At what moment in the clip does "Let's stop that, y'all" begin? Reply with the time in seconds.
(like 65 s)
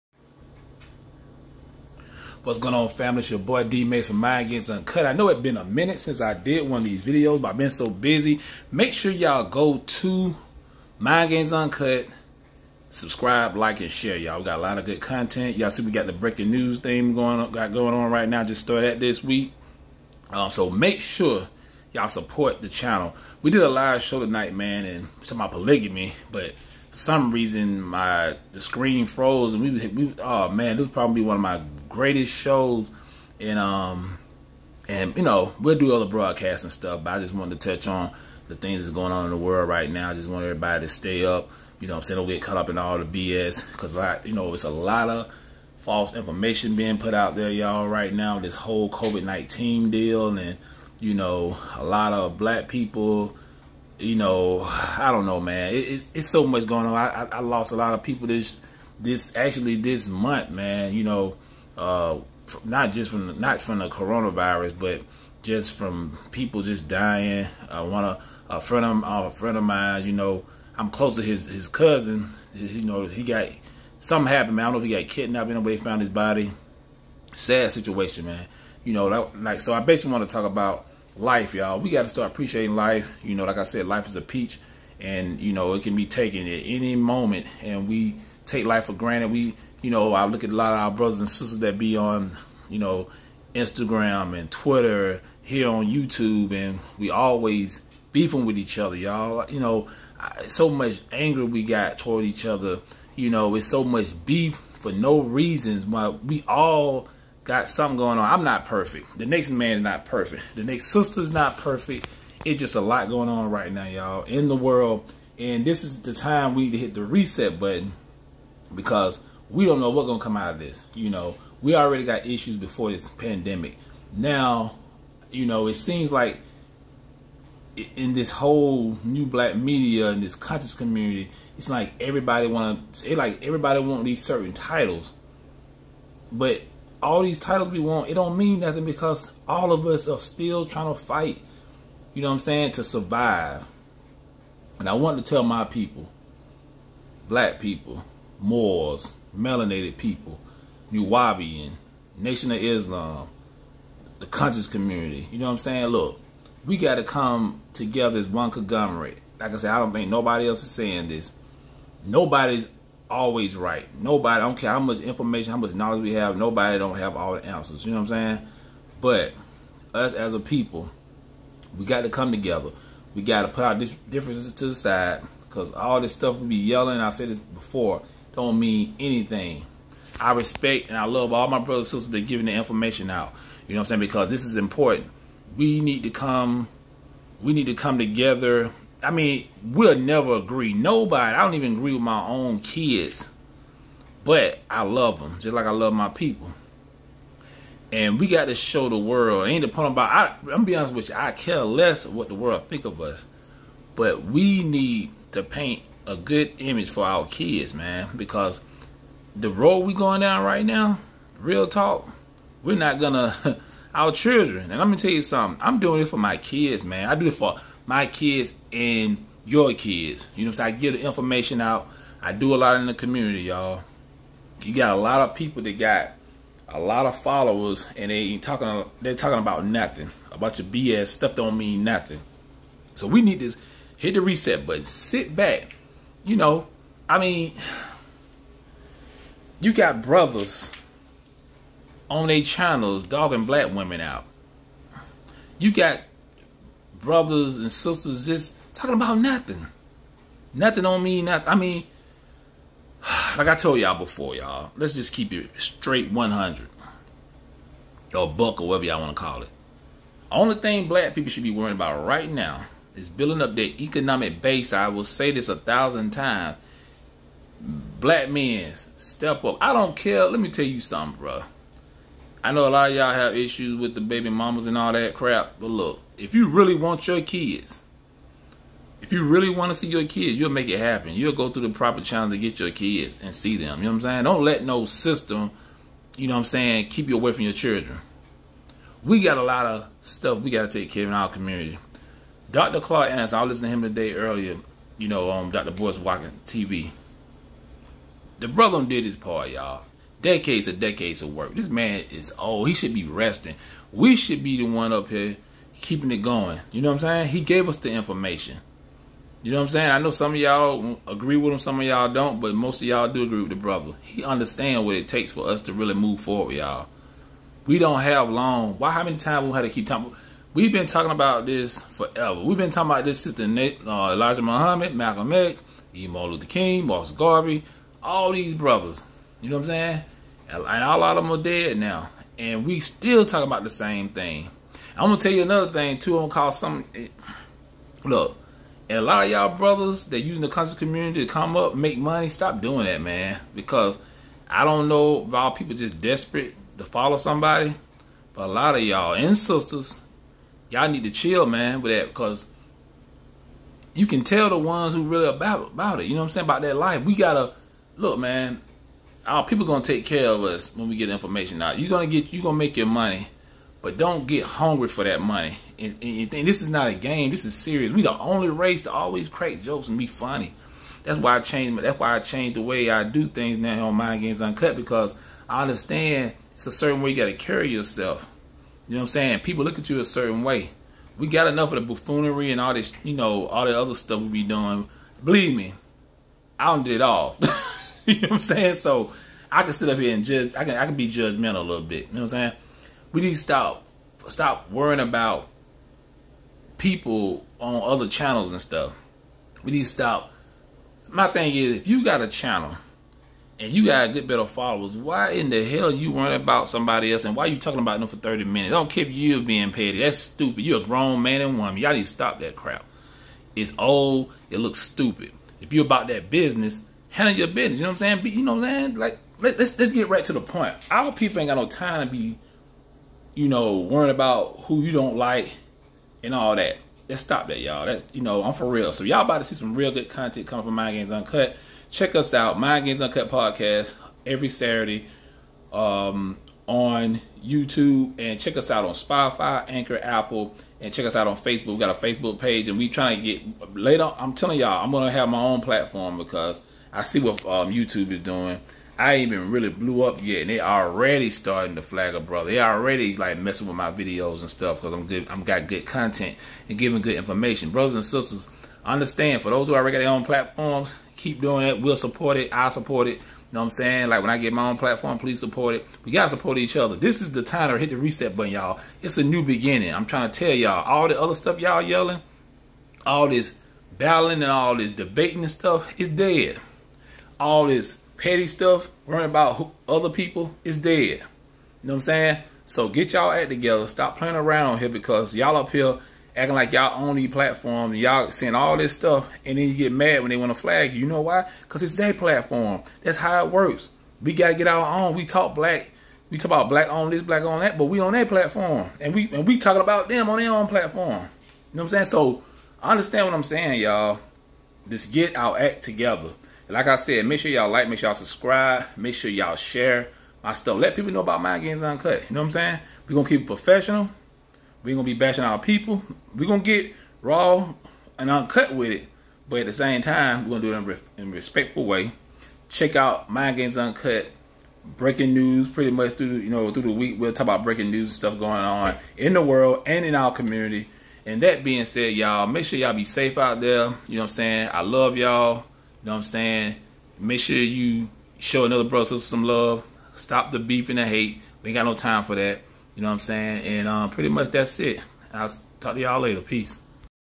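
427 s.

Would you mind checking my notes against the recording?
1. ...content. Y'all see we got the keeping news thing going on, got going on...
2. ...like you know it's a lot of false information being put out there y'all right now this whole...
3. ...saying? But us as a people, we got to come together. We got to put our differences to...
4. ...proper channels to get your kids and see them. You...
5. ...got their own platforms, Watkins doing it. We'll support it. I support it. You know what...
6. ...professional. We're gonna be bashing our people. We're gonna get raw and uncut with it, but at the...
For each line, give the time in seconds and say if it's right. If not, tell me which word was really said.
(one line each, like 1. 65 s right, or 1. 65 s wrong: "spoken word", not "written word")
1. 15 s wrong: "breaking", not "keeping"
2. 43 s right
3. 168 s right
4. 281 s right
5. 459 s wrong: "Keep", not "Watkins"
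6. 513 s right.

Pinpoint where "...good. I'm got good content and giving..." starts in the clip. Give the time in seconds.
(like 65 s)
455 s.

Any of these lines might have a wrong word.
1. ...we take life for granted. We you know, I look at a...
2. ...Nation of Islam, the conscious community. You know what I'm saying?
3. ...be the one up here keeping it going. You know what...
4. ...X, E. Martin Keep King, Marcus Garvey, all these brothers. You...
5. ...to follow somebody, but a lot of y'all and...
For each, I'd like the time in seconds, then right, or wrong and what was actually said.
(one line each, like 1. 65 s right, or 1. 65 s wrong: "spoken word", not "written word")
1. 87 s right
2. 152 s right
3. 304 s right
4. 325 s wrong: "Luther", not "Keep"
5. 346 s right.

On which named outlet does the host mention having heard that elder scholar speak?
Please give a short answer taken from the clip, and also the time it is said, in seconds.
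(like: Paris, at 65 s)
Dr. Boyce Watkins TV, at 295 s.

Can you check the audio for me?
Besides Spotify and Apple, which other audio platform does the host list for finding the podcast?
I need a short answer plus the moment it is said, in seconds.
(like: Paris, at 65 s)
Anchor, at 439 s.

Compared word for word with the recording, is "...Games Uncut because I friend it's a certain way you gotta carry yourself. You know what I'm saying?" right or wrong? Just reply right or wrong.
wrong.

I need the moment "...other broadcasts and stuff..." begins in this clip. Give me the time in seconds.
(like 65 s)
35 s.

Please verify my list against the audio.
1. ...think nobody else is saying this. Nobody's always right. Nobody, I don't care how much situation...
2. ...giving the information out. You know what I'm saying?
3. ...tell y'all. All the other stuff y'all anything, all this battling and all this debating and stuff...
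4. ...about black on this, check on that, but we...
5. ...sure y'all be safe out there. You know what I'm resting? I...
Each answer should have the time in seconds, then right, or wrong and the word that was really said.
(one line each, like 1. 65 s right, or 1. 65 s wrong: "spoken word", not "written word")
1. 159 s wrong: "information", not "situation"
2. 182 s right
3. 470 s wrong: "yelling", not "anything"
4. 496 s wrong: "black", not "check"
5. 532 s wrong: "saying", not "resting".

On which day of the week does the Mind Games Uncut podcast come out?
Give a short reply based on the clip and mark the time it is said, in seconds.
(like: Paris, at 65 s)
Saturday, at 434 s.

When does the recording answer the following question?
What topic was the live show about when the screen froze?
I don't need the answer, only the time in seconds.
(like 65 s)
25 s.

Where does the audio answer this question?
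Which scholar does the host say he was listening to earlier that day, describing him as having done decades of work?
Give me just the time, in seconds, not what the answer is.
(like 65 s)
292 s.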